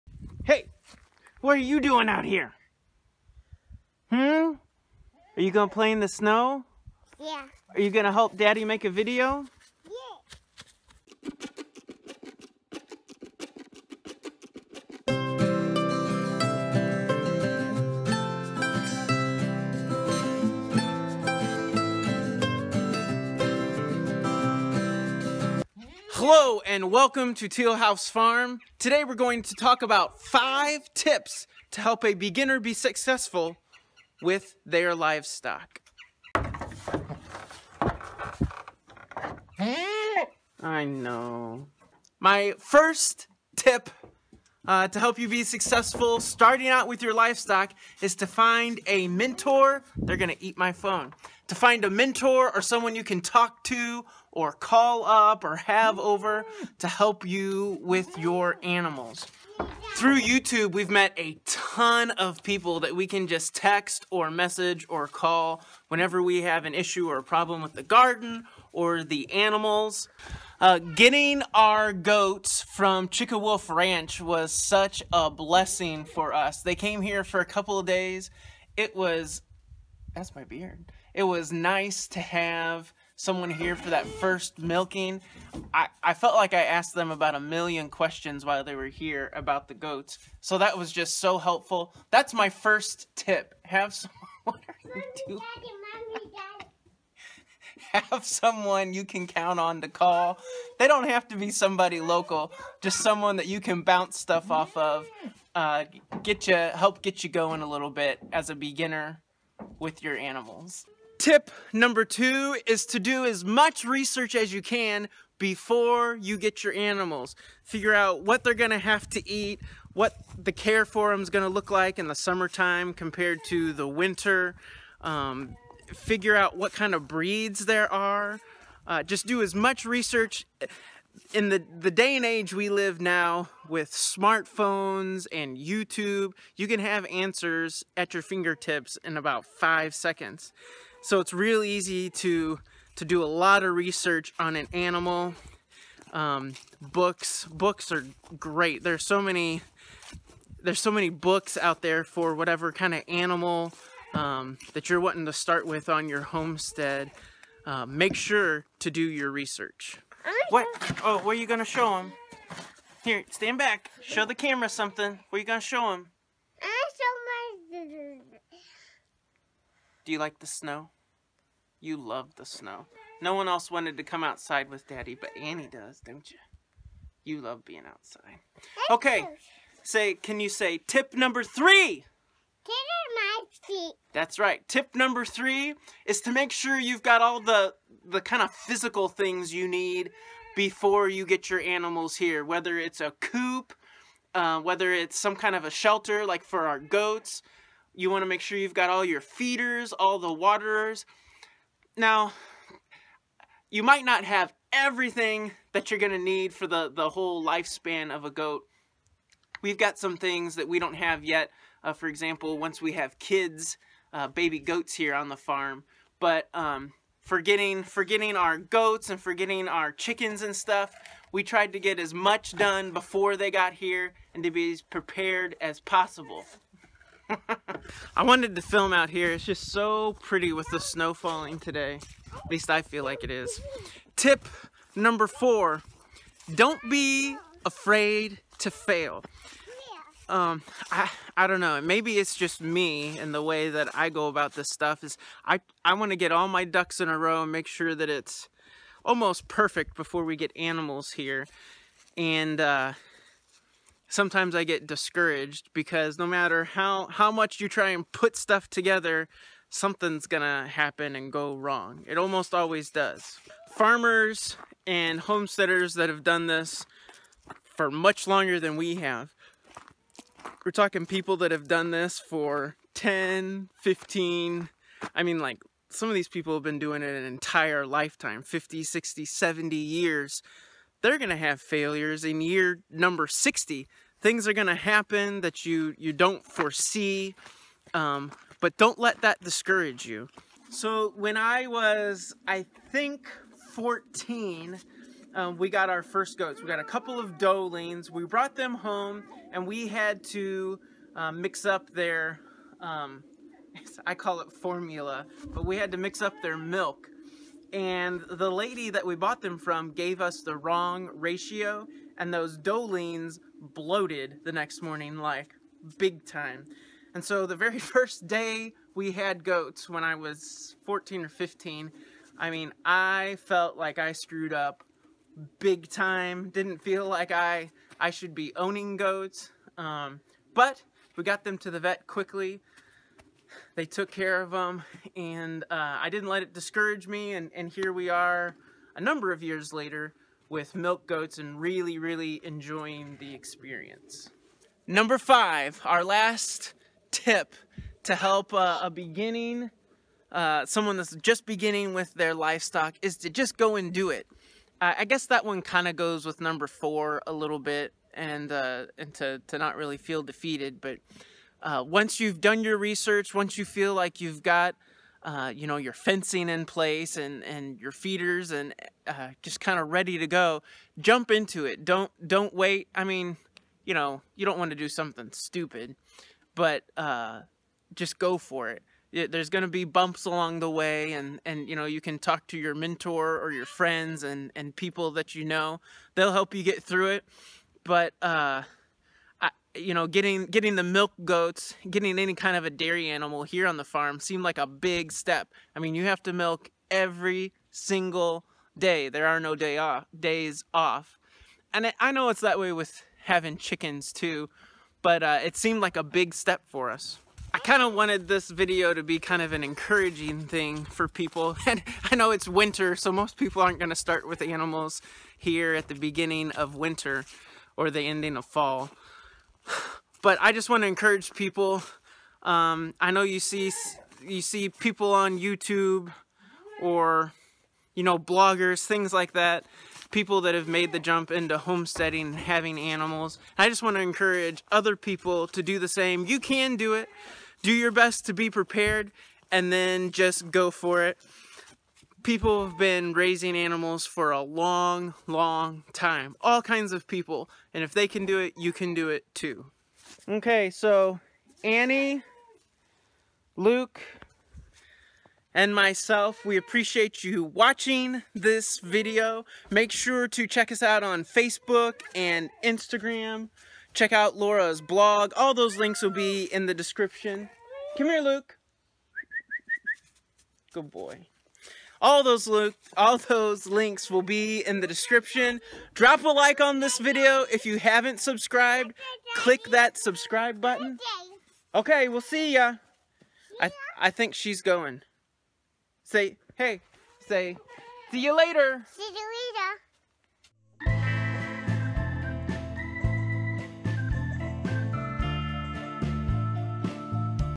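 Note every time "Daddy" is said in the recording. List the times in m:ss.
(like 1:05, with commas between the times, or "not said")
0:08, 2:54.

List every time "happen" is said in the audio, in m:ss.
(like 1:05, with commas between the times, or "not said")
4:20, 4:44.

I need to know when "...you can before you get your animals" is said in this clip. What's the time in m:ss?
1:54.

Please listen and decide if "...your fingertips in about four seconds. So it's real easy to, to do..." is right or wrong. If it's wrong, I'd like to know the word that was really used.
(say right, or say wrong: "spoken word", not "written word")
wrong: "five", not "four".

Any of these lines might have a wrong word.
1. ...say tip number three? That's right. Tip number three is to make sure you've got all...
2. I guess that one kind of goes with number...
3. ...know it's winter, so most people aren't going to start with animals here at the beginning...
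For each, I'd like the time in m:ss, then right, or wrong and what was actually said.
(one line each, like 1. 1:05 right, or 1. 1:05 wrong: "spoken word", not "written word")
1. 3:00 right
2. 5:54 right
3. 6:52 right.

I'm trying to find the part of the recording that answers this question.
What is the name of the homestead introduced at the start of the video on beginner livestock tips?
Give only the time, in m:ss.
0:27.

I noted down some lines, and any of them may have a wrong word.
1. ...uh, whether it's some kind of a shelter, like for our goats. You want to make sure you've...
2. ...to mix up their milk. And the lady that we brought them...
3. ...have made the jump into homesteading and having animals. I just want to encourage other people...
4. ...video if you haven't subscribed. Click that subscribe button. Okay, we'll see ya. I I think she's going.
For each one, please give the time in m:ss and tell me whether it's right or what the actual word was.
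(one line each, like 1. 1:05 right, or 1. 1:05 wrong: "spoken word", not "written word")
1. 3:14 right
2. 5:05 wrong: "bought", not "brought"
3. 7:10 right
4. 7:56 right.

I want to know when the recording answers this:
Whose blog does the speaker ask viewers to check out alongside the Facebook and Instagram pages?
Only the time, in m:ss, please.
7:44.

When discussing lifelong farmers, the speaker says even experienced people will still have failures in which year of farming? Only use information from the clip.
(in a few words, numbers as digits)
Year 60.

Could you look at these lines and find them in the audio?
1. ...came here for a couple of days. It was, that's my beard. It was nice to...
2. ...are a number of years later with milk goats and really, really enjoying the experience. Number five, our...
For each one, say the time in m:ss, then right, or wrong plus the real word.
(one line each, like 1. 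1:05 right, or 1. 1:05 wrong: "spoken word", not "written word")
1. 1:16 right
2. 5:38 right.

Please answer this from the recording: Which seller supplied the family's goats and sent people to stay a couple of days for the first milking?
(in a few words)
Wolf Ranch.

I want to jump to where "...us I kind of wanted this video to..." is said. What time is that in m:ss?
6:46.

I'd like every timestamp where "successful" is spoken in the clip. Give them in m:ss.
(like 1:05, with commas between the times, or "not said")
0:32, 0:45.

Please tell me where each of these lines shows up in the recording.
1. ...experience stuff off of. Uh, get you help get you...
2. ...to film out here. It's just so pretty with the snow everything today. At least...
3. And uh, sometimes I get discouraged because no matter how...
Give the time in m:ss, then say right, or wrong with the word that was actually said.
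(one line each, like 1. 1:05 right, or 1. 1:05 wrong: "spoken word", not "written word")
1. 1:43 wrong: "bounce", not "experience"
2. 3:48 wrong: "falling", not "everything"
3. 4:12 right.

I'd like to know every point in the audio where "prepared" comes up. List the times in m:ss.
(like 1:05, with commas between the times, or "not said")
3:44, 7:18.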